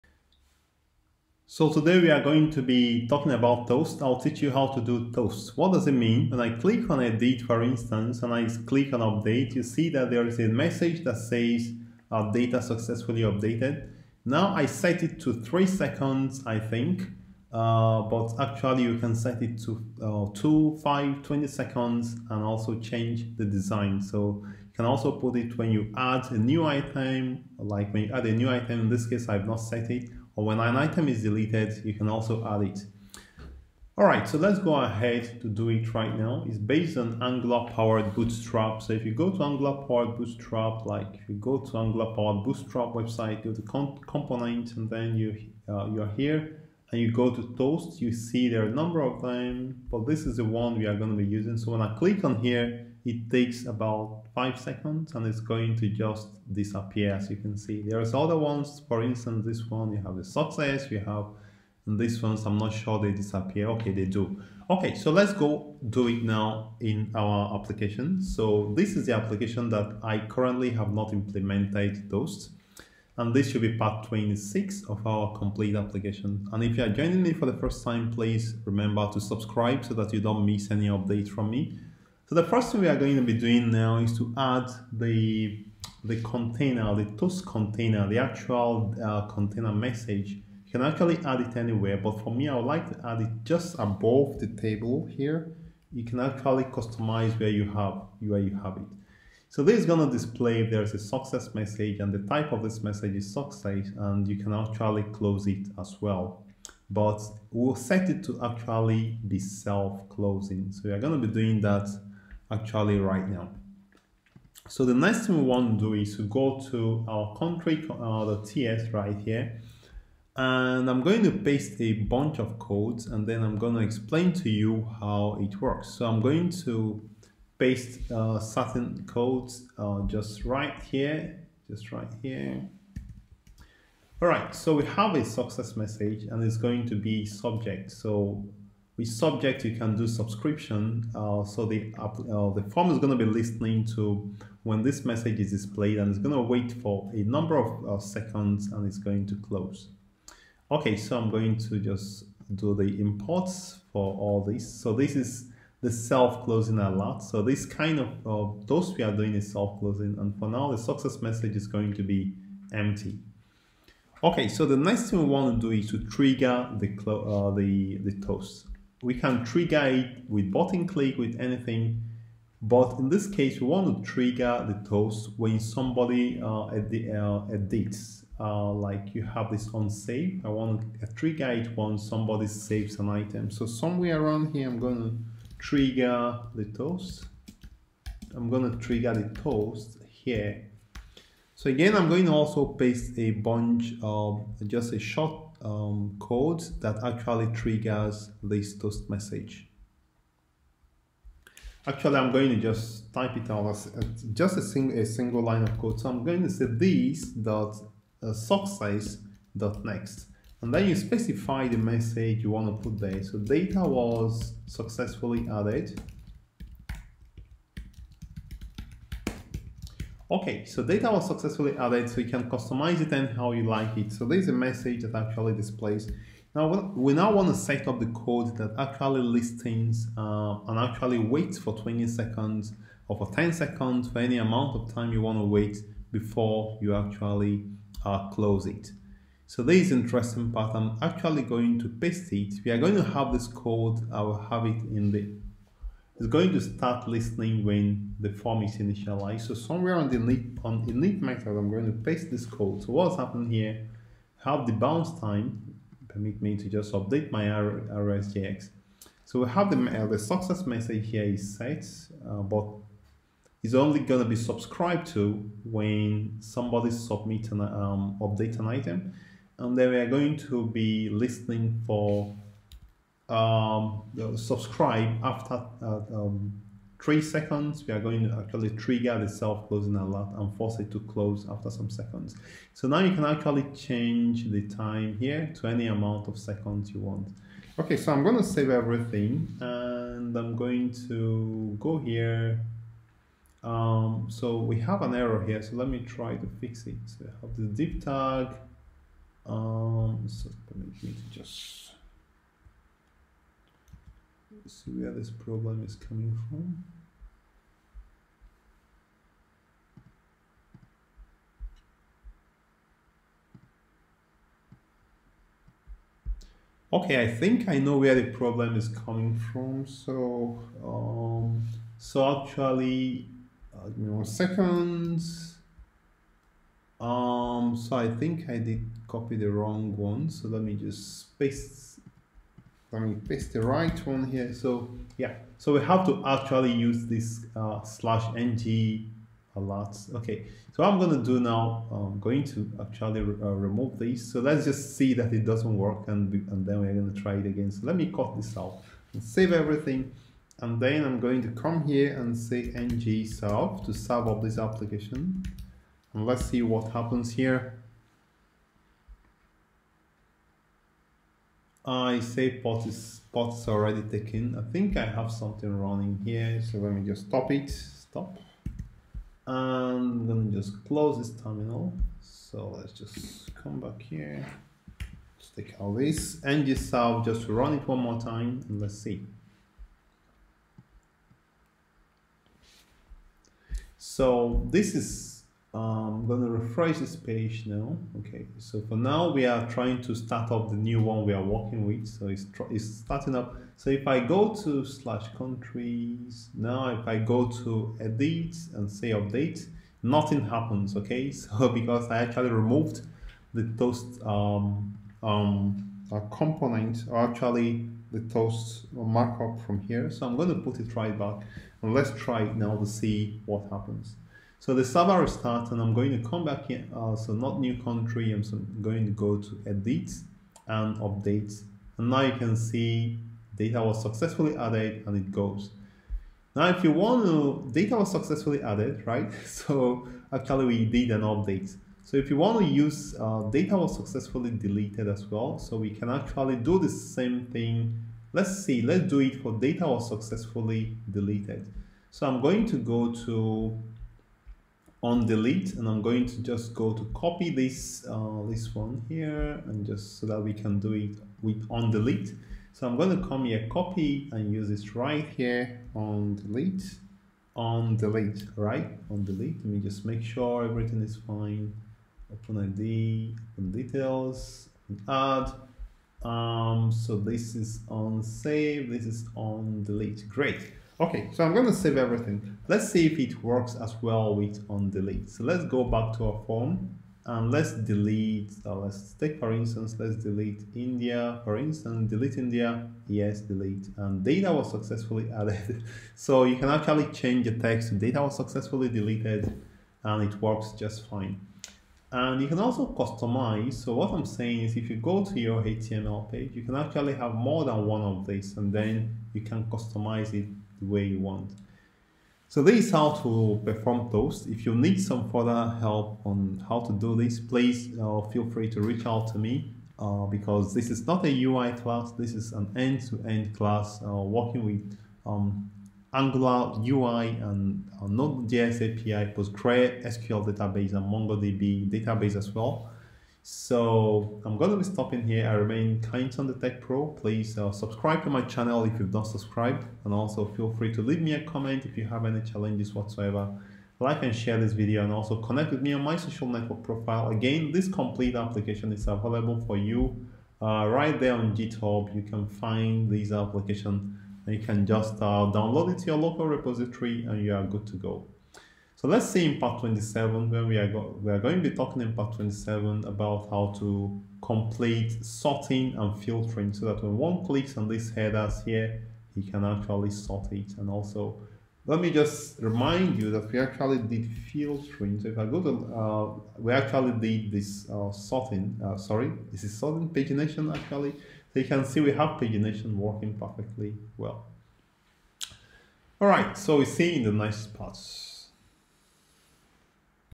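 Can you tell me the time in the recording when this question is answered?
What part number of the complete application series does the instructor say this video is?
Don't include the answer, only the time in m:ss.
1:13.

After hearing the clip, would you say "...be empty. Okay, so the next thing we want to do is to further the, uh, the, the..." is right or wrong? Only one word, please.
wrong.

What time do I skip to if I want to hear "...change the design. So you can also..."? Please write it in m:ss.
0:22.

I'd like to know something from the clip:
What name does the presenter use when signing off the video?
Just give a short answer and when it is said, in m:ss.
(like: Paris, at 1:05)
Kindson the Tech Pro, at 8:46.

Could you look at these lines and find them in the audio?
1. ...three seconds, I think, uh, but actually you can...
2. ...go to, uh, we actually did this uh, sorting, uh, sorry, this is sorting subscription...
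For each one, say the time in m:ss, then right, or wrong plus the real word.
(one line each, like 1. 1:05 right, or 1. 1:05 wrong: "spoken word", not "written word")
1. 0:15 right
2. 9:25 wrong: "pagination", not "subscription".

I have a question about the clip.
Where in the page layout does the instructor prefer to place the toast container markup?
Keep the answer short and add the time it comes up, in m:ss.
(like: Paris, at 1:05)
Above the table, at 1:33.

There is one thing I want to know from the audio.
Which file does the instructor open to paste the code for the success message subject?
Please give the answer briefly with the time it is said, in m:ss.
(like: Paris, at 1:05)
country.ts, at 1:57.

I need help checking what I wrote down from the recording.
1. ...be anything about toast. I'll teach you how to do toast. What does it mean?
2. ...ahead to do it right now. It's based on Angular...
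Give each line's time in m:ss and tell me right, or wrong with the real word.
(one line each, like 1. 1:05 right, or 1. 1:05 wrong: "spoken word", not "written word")
1. 0:02 wrong: "talking", not "anything"
2. 0:34 right.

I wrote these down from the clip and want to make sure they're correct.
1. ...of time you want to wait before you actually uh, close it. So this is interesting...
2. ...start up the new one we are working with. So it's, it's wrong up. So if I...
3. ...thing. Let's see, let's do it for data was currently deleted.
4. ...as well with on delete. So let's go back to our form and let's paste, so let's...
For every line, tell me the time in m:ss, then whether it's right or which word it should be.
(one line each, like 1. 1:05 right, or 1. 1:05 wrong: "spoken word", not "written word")
1. 3:54 right
2. 6:30 wrong: "starting", not "wrong"
3. 7:17 wrong: "successfully", not "currently"
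4. 7:53 wrong: "delete", not "paste".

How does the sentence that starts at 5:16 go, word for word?
Okay, I think I know where the problem is coming from.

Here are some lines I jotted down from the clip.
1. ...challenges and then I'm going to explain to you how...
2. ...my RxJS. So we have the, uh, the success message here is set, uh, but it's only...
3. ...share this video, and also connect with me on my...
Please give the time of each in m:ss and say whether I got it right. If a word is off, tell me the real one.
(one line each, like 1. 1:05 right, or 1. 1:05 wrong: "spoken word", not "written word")
1. 2:02 wrong: "codes", not "challenges"
2. 4:17 right
3. 8:54 right.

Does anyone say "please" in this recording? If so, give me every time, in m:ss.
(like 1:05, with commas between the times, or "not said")
1:18, 8:27, 8:47.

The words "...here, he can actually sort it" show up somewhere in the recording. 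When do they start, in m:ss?
9:18.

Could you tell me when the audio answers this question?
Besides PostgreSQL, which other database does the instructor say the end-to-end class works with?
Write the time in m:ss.
8:41.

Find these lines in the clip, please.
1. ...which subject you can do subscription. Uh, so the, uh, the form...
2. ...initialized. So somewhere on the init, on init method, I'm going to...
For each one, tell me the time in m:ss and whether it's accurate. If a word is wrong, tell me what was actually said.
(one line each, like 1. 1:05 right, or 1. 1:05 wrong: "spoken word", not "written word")
1. 2:18 right
2. 4:08 right.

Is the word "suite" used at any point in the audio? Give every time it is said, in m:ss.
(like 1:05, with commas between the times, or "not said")
not said.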